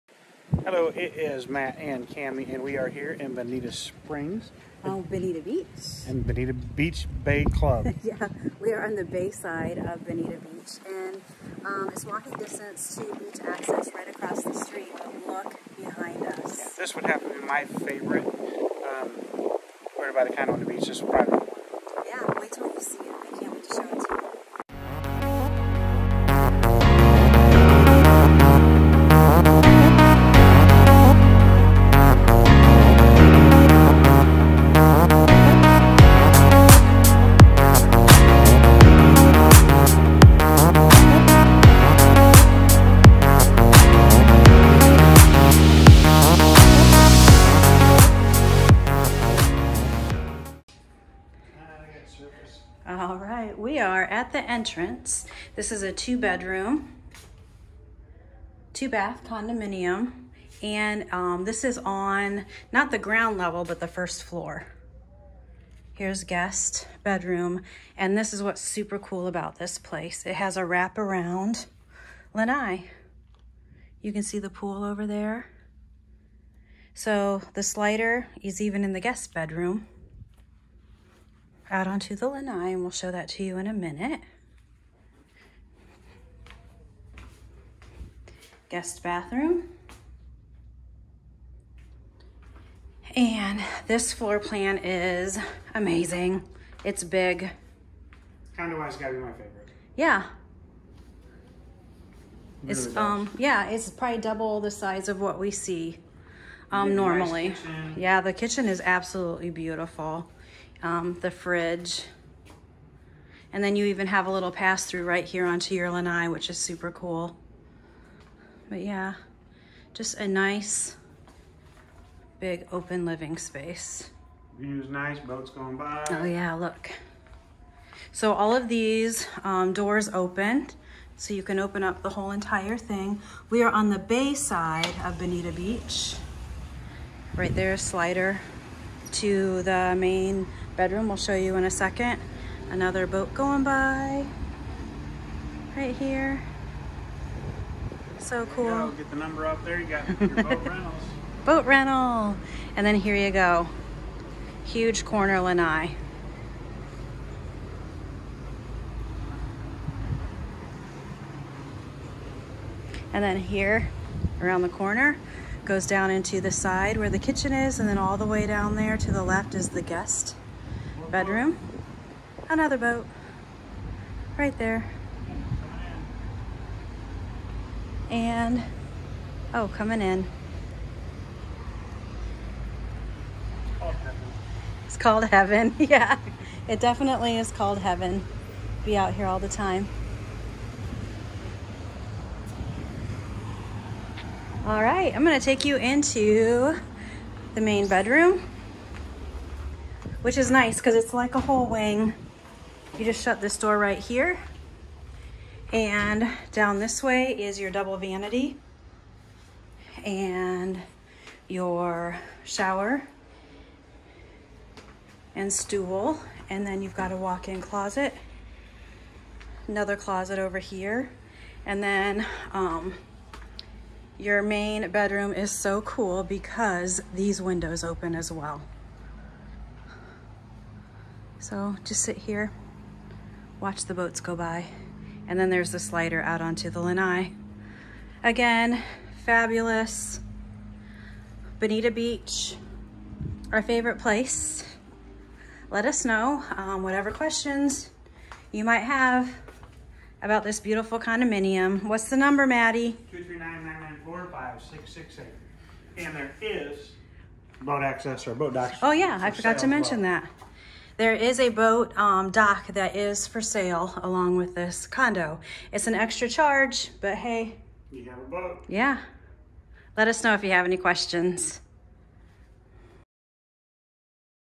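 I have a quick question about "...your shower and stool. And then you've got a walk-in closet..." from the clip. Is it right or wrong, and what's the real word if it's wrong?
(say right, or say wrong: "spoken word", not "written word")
right.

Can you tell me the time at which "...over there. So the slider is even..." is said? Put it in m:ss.
1:14.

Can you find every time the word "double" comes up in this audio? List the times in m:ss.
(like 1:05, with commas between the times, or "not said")
1:44, 3:27.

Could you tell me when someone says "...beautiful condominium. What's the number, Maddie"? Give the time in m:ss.
4:10.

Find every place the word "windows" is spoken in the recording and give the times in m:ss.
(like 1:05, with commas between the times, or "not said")
3:47.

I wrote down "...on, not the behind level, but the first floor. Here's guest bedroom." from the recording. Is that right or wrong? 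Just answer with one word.
wrong.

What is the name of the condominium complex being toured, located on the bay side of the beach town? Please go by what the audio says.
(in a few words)
Bonita Beach Bay Club.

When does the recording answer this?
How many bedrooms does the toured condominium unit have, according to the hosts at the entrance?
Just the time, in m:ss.
0:55.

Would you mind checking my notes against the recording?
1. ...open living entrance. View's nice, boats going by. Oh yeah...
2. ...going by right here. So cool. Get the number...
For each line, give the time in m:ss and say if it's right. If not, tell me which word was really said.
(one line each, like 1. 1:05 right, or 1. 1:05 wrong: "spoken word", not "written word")
1. 2:02 wrong: "space", not "entrance"
2. 2:23 right.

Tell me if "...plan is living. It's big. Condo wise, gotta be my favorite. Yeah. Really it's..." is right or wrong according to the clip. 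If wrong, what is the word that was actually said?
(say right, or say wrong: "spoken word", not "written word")
wrong: "amazing", not "living".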